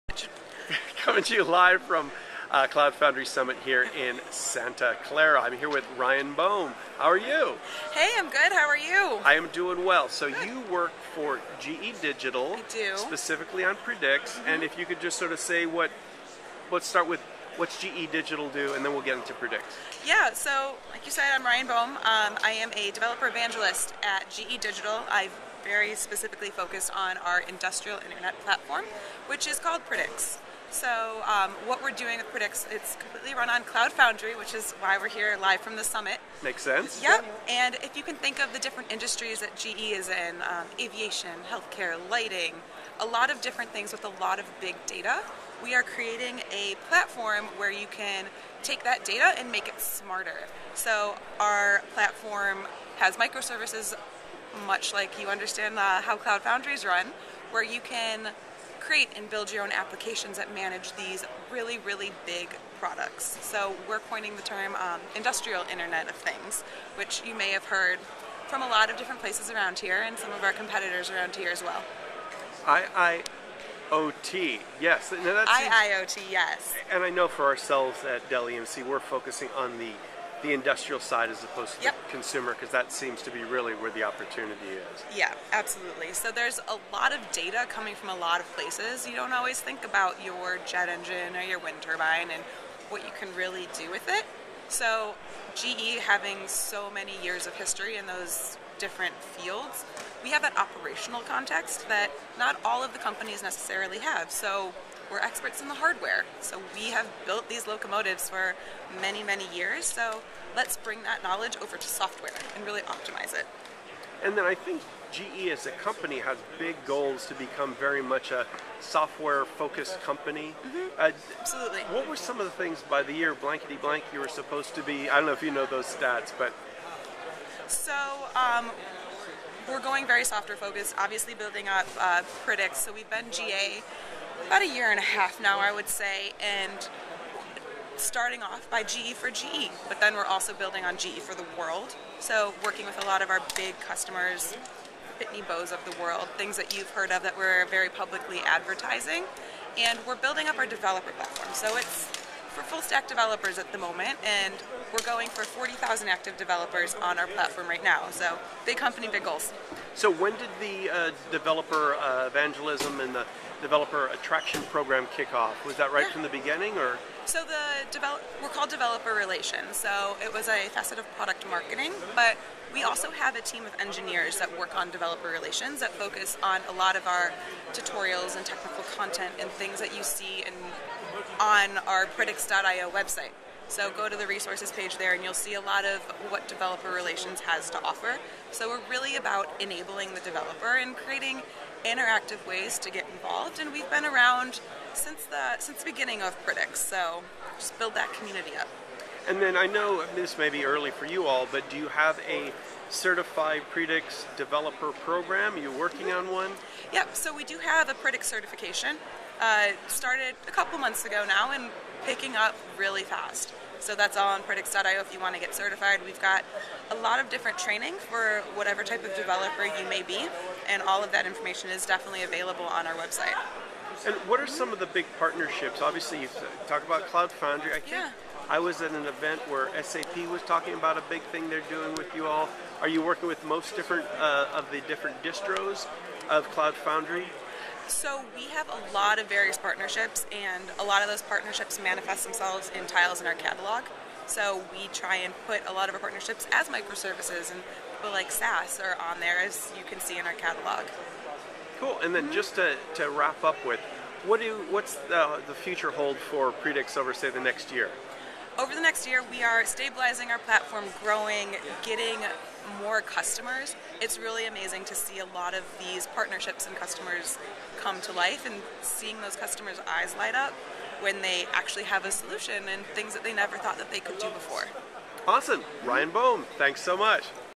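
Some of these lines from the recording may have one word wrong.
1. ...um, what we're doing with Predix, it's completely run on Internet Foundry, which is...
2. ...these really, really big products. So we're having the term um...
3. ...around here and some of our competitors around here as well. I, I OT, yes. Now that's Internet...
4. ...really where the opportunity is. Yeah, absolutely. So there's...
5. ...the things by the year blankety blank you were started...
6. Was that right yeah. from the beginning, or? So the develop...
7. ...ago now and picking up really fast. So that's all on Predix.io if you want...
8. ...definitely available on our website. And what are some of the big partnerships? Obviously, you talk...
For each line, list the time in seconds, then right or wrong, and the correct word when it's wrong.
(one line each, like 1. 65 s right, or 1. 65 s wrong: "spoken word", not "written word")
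1. 31 s wrong: "Cloud", not "Internet"
2. 60 s wrong: "coining", not "having"
3. 69 s wrong: "IIoT", not "Internet"
4. 83 s right
5. 122 s wrong: "supposed", not "started"
6. 165 s right
7. 211 s right
8. 221 s right.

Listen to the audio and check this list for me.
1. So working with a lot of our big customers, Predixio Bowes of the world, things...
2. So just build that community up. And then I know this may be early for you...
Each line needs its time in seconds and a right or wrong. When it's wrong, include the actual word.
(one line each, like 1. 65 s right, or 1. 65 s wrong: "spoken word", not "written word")
1. 142 s wrong: "Pitney", not "Predixio"
2. 196 s right.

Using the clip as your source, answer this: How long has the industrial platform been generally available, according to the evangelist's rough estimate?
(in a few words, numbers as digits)
About a year and a half.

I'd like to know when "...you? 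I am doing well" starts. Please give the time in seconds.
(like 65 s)
8 s.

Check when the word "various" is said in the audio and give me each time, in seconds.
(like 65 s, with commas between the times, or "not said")
239 s.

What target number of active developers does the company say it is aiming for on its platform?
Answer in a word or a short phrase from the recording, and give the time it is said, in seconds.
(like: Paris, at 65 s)
40,000, at 155 s.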